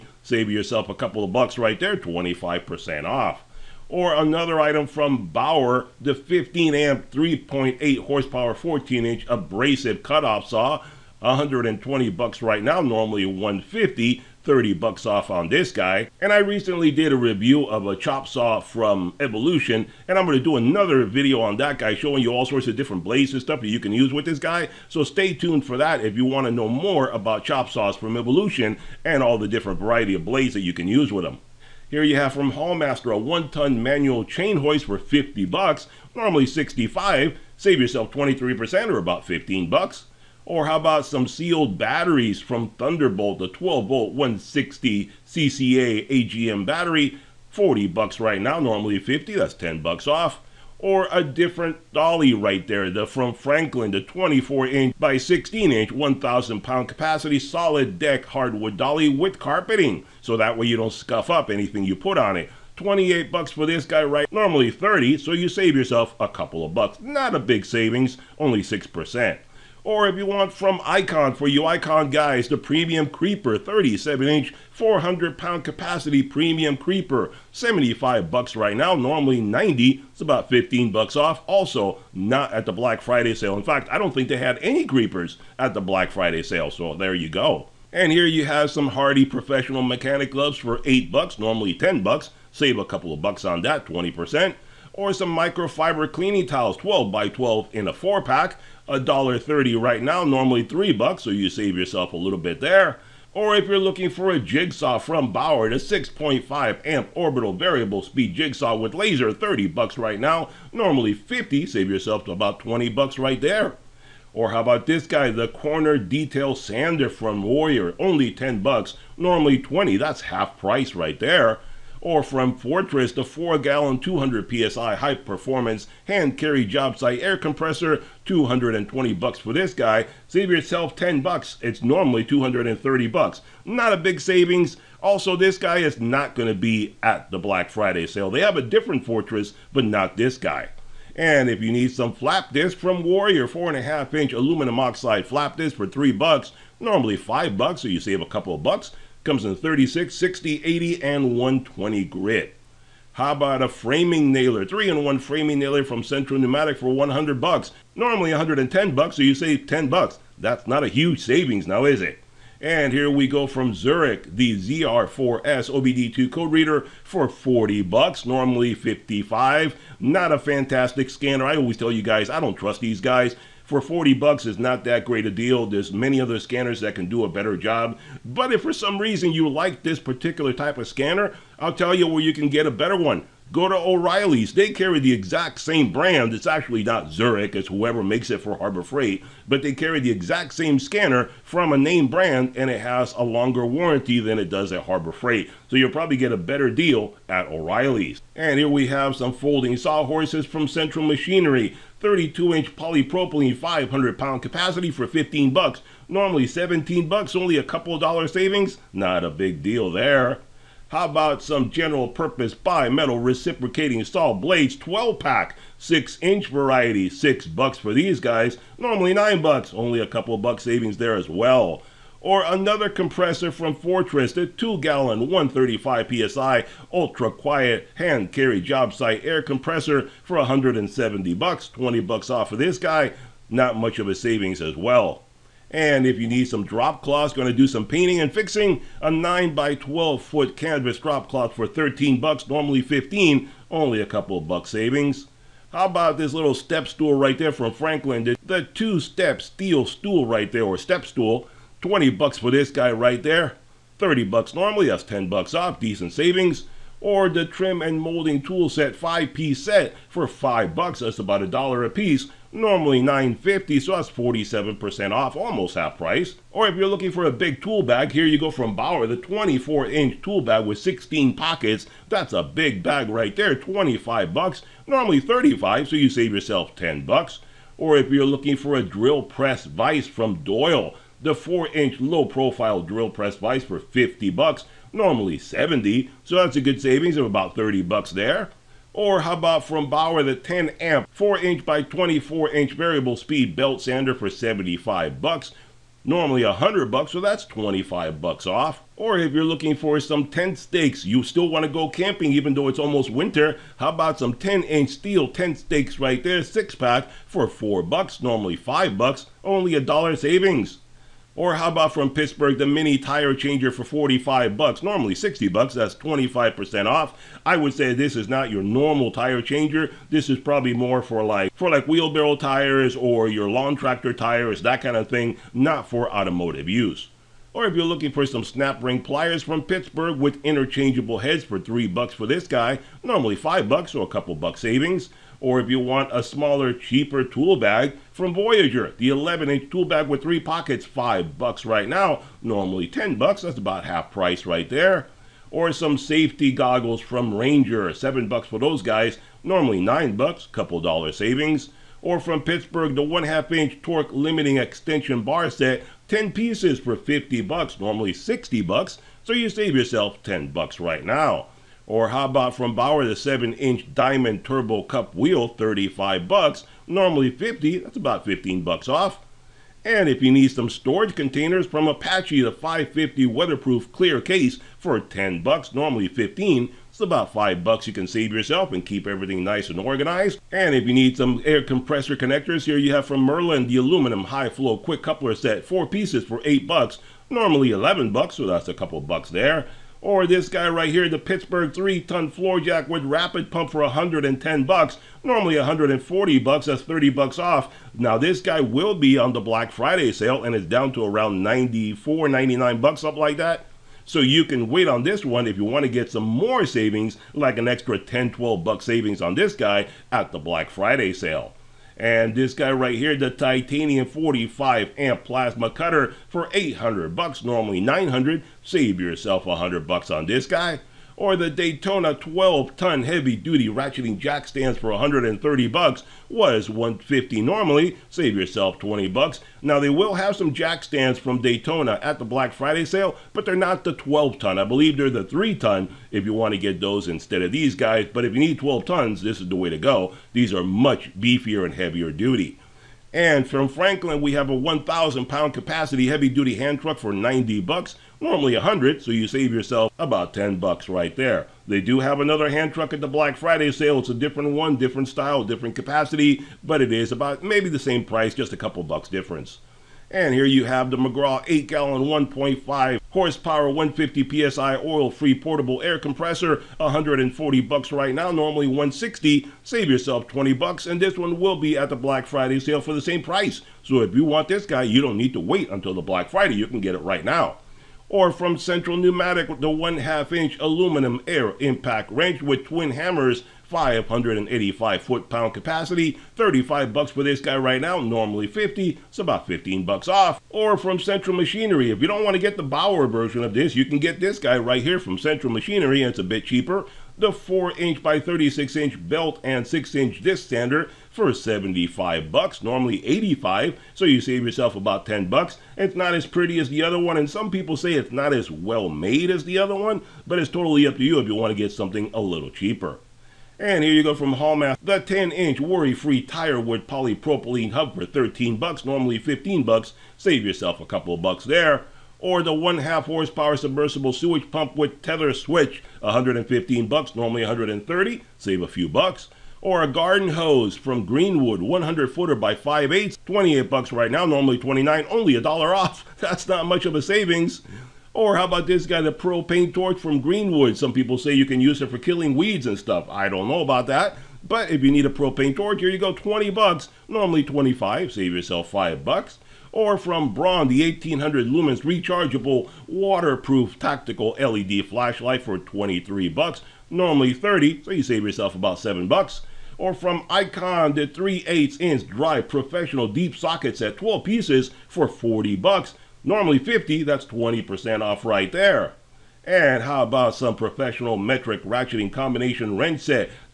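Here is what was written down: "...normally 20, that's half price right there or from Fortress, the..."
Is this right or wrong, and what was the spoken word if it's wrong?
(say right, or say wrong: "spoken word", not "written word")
right.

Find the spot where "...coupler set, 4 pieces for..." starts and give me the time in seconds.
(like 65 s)
385 s.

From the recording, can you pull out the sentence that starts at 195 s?
So you'll probably get a better deal at O'Reilly's.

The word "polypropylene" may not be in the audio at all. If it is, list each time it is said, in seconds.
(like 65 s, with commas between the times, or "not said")
202 s, 516 s.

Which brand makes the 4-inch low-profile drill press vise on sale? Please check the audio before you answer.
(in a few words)
Doyle.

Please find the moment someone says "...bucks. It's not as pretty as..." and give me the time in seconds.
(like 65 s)
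505 s.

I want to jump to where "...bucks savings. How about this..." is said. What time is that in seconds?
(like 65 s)
244 s.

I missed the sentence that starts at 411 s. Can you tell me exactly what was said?
And this guy right here, the titanium 45 amp plasma cutter for 800 bucks, normally 900.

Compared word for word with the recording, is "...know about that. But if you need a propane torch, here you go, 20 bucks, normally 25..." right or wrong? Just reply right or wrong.
right.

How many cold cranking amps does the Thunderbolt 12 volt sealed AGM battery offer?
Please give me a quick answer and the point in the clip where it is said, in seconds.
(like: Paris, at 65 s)
160, at 44 s.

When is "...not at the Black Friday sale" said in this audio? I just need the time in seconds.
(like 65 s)
82 s.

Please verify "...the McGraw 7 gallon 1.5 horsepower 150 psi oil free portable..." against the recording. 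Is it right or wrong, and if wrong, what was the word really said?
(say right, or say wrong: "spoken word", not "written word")
wrong: "8", not "7".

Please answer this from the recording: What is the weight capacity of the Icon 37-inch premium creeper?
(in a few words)
400 pounds.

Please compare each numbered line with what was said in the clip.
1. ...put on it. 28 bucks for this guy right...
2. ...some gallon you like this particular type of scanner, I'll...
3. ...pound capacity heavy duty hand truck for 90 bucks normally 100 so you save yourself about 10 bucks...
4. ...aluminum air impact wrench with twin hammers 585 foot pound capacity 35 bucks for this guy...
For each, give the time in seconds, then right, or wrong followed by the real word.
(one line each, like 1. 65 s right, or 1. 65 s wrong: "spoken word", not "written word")
1. 61 s right
2. 178 s wrong: "reason", not "gallon"
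3. 445 s right
4. 480 s right.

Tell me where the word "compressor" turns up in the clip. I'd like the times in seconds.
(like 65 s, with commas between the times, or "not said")
127 s, 222 s, 229 s, 381 s, 465 s.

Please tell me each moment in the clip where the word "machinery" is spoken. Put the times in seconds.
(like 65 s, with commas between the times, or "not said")
201 s, 491 s, 495 s.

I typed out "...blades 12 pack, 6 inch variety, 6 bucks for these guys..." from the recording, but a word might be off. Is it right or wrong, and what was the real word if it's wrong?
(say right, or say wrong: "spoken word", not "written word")
right.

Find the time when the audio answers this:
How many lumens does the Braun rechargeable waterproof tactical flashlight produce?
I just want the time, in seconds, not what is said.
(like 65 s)
550 s.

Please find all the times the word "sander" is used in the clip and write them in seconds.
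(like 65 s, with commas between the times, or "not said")
116 s, 293 s, 500 s.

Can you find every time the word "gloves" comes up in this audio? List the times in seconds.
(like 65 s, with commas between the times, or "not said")
90 s.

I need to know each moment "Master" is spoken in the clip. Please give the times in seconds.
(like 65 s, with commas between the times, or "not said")
32 s, 514 s.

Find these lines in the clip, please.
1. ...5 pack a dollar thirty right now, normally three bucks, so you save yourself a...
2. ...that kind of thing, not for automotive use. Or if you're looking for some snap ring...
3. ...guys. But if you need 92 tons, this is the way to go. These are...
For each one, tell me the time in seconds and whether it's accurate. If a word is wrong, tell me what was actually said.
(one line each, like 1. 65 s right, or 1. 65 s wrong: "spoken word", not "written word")
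1. 97 s wrong: "4", not "5"
2. 324 s right
3. 437 s wrong: "12", not "92".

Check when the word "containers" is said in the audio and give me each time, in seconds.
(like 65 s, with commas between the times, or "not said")
371 s.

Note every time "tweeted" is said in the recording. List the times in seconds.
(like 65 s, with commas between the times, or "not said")
not said.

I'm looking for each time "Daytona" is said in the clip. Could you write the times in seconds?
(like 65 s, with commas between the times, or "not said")
421 s, 431 s.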